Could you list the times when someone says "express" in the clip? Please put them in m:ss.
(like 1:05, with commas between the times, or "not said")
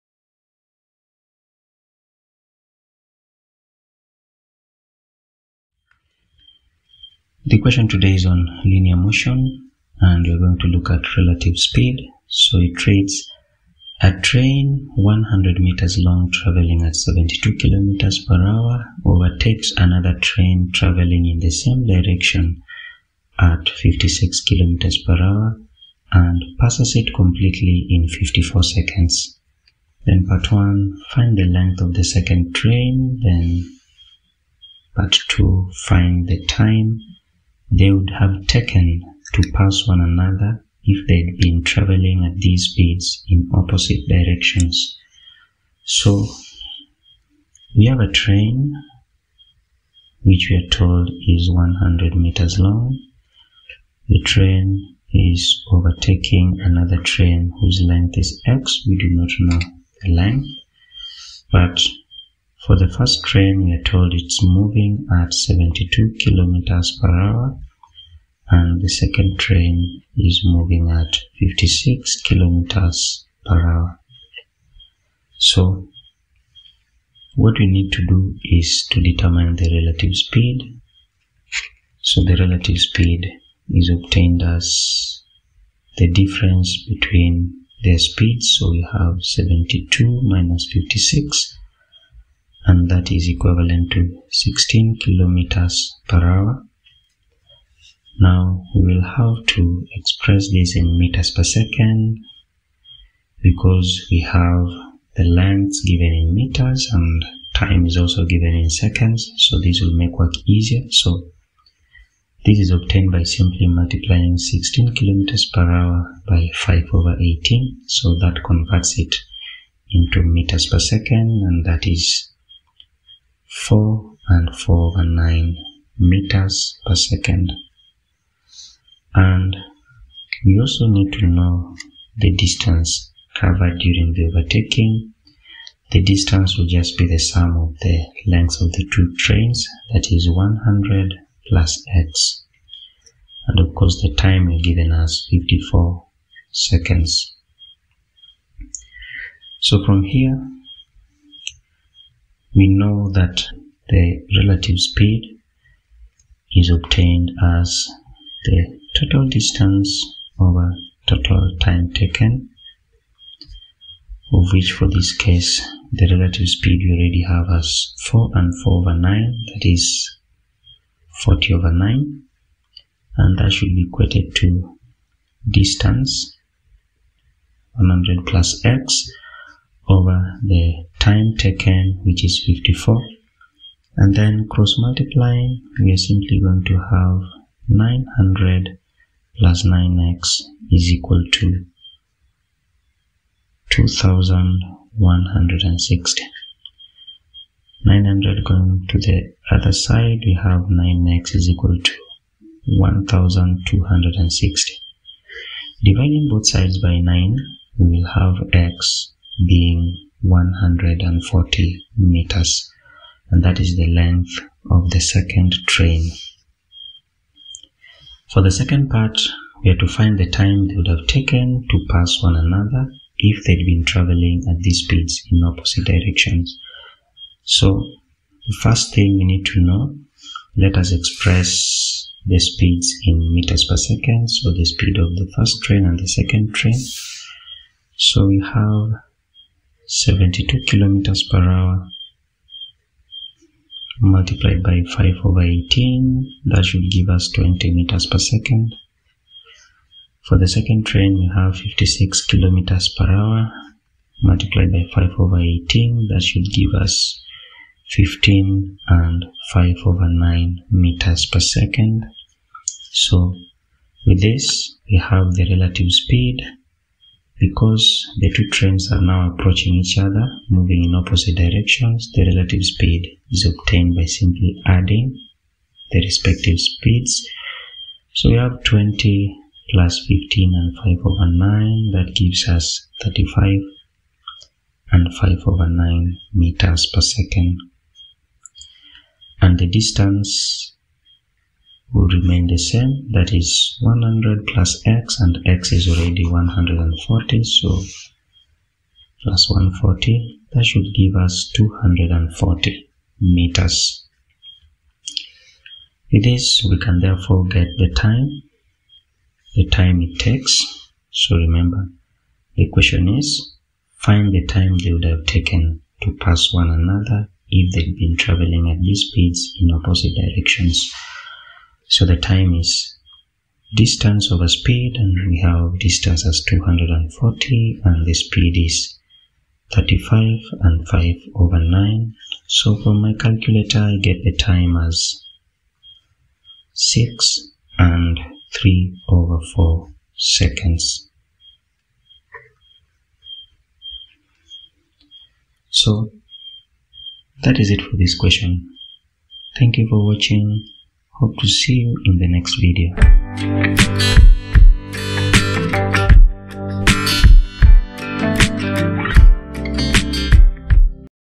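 1:39, 3:50.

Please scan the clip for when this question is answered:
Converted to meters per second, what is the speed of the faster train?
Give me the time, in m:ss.
4:07.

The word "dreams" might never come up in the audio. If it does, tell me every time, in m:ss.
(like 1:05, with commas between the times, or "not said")
not said.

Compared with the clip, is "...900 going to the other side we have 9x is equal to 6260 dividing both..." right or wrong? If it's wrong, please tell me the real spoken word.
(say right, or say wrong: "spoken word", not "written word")
wrong: "1260", not "6260".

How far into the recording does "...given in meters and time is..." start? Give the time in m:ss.
1:45.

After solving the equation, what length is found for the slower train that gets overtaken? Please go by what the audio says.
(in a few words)
140 meters.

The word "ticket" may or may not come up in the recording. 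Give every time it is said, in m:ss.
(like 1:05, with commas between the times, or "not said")
not said.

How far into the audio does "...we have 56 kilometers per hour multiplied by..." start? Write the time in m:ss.
4:11.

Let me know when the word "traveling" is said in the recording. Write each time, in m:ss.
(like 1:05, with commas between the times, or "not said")
0:16, 0:20, 0:41, 3:43, 5:18.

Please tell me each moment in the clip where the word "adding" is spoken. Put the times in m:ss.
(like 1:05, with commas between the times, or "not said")
4:34.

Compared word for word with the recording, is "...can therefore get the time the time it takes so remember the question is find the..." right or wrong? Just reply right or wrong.
right.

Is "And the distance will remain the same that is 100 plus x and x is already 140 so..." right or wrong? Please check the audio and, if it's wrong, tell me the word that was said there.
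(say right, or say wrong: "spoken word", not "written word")
right.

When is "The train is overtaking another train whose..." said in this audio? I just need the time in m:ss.
0:54.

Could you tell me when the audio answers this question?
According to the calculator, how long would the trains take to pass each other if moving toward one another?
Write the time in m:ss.
5:36.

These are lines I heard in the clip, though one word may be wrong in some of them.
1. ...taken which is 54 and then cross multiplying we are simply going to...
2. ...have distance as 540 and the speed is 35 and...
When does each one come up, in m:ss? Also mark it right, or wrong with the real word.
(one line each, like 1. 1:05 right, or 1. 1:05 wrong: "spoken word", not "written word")
1. 3:01 right
2. 5:25 wrong: "240", not "540".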